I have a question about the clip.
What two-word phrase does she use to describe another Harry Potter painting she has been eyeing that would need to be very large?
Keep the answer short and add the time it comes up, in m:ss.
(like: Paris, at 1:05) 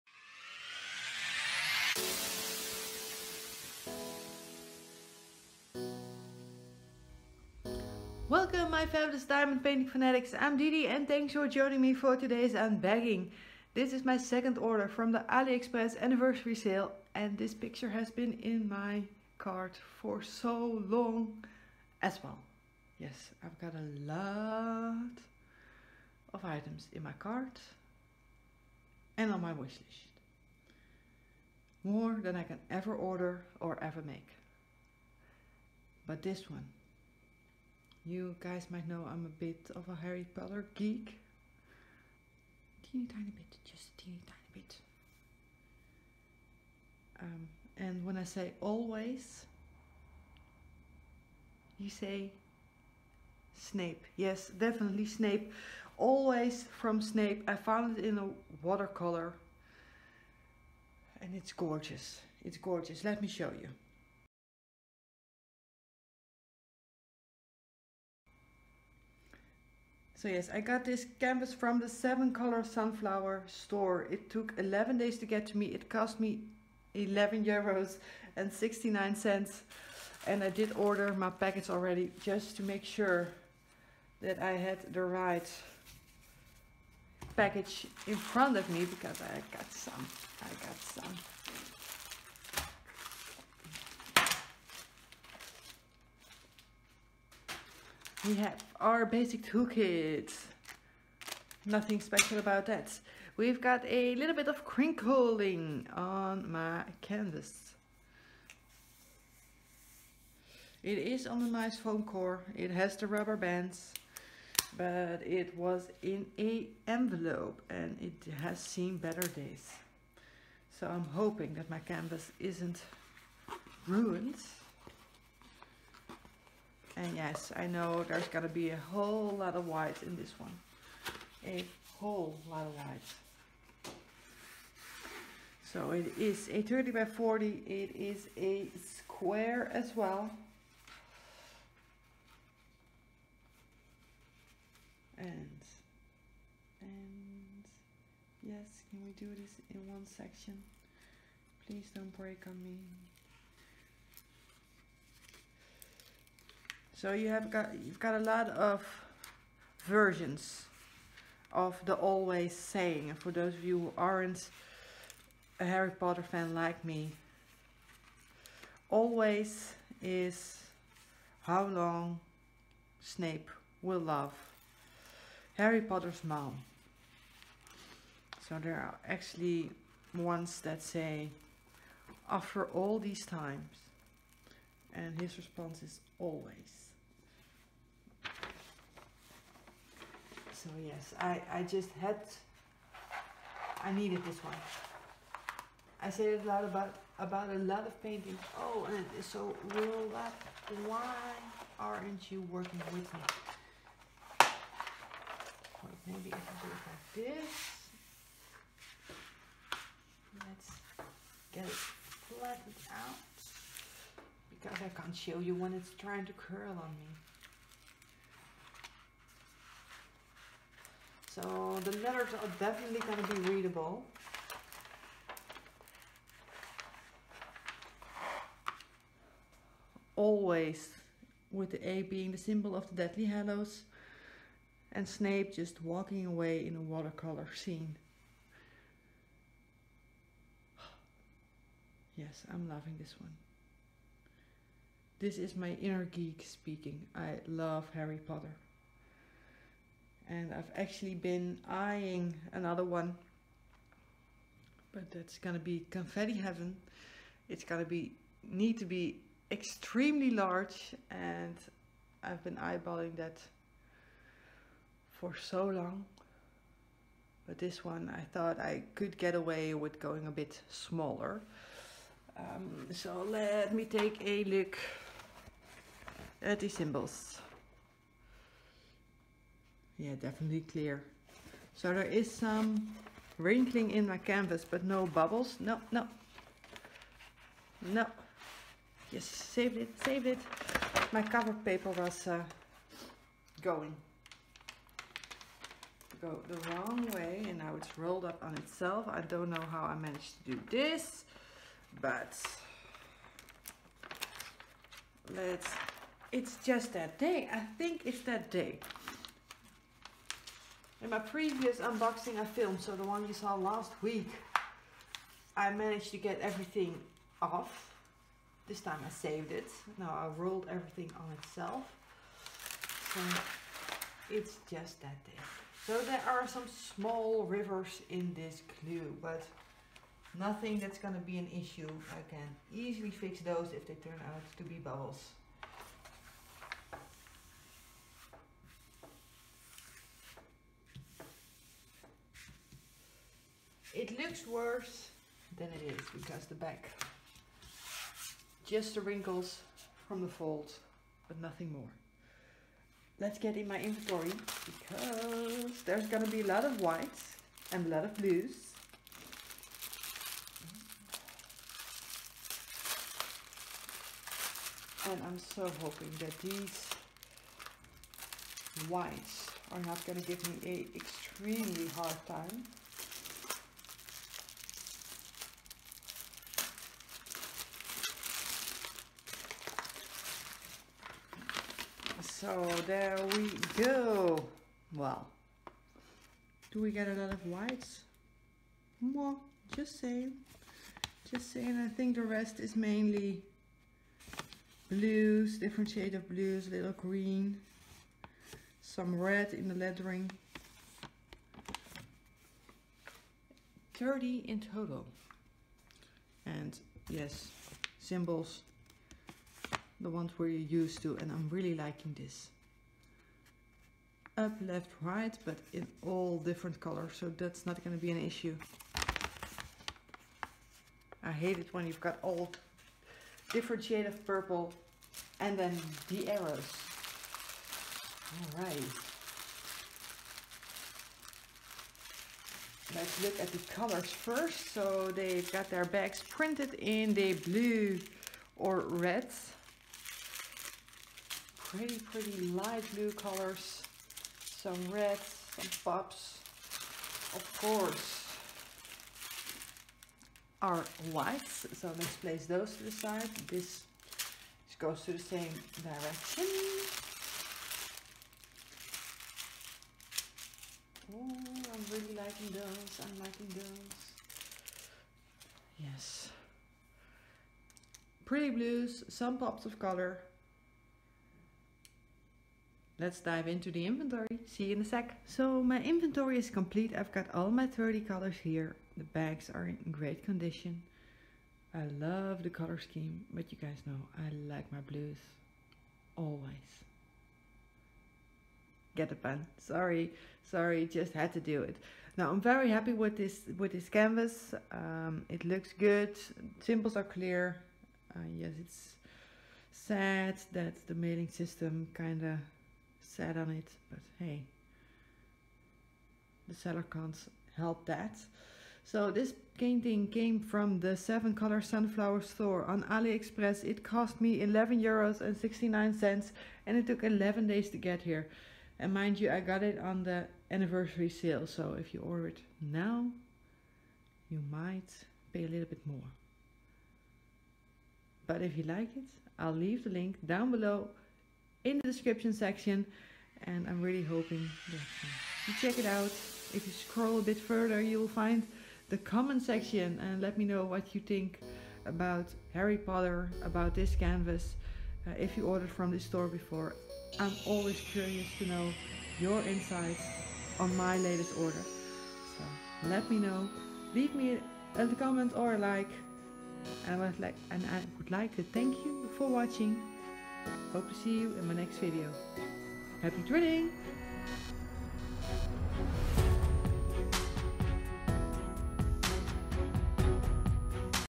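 confetti heaven, at 4:15.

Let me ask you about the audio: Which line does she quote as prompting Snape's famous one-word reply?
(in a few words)
after all these times.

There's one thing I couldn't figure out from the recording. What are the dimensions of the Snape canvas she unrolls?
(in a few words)
30 by 40.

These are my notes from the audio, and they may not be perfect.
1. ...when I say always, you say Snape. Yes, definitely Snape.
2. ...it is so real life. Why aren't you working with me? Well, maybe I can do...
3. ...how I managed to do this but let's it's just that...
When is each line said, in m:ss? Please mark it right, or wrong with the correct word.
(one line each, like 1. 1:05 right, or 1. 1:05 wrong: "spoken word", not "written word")
1. 0:48 right
2. 3:18 right
3. 4:59 right.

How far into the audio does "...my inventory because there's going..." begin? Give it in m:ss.
5:53.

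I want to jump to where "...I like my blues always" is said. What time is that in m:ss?
8:04.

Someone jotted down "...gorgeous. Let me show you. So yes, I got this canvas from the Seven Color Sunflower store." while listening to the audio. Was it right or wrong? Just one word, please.
right.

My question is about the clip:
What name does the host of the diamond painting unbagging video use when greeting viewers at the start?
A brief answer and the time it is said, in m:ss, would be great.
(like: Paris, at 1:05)
Didi, at 0:10.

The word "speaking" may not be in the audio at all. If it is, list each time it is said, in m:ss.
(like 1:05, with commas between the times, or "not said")
4:06.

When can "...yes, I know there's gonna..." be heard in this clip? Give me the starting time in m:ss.
2:07.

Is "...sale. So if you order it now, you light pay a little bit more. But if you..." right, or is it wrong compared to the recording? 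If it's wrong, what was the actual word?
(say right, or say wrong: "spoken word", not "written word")
wrong: "might", not "light".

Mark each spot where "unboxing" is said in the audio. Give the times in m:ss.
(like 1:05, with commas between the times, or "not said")
5:11.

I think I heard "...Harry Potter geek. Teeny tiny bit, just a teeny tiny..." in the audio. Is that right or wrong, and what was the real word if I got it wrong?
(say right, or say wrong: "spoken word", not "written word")
right.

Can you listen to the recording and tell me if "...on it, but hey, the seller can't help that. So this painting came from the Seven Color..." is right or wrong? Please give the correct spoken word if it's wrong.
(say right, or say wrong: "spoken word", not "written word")
right.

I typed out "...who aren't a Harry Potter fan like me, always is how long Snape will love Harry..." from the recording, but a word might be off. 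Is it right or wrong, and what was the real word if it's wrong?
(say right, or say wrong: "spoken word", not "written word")
right.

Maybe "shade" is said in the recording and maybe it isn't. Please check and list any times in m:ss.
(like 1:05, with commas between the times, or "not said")
6:35, 7:03.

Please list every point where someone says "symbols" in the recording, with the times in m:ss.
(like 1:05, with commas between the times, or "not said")
3:52, 4:36, 6:47, 8:16.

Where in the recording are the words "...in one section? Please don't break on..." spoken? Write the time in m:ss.
2:29.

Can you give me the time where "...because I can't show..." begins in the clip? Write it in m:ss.
3:34.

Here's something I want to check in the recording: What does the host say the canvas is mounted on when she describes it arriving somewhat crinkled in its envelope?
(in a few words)
foam core.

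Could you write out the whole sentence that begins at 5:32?
I can easily fix those if they turn out to be bubbles.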